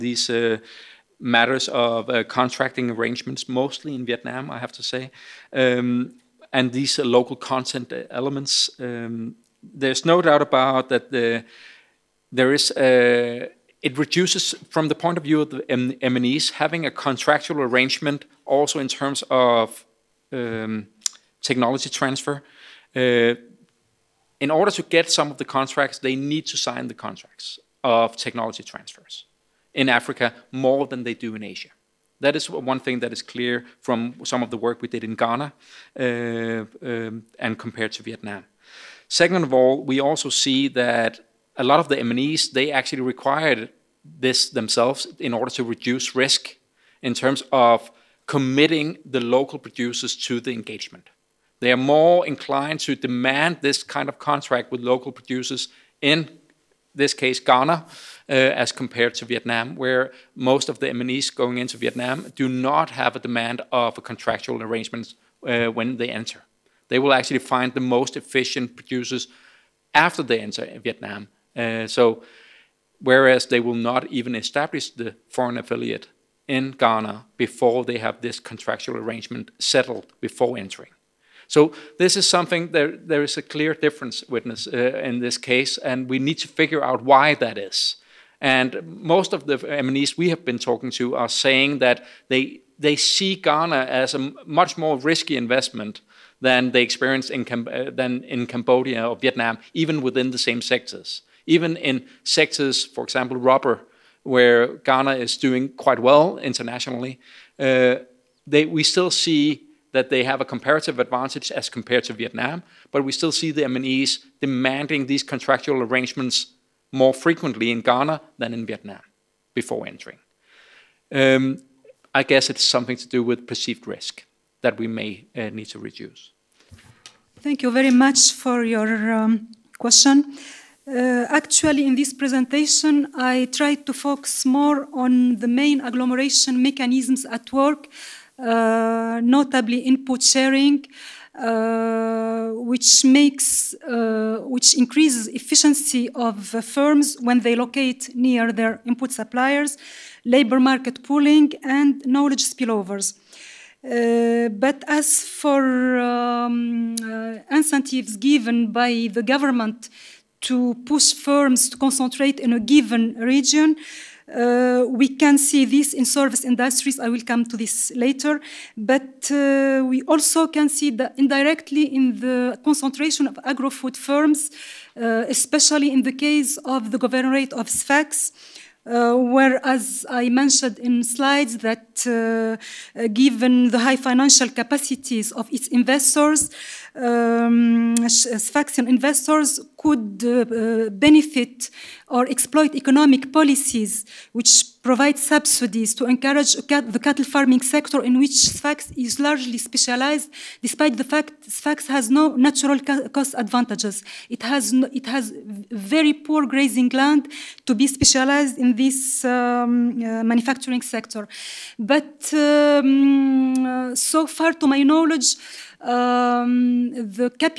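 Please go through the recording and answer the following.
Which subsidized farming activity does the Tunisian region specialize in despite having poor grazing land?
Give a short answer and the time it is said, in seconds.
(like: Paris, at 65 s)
cattle farming, at 197 s.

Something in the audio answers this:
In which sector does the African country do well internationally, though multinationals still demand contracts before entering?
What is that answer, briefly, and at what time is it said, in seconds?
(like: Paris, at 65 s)
rubber, at 103 s.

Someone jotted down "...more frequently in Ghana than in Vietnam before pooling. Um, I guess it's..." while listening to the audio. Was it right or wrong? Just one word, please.
wrong.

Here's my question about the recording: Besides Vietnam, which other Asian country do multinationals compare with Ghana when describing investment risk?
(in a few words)
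Cambodia.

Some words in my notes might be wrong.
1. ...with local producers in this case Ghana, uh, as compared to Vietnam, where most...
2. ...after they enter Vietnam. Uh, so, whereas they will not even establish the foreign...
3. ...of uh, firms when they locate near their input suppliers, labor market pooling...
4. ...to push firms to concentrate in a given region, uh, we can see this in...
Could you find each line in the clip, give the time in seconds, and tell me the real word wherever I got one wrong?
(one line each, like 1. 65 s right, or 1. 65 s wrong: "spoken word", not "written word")
1. 54 s right
2. 69 s right
3. 146 s right
4. 160 s right.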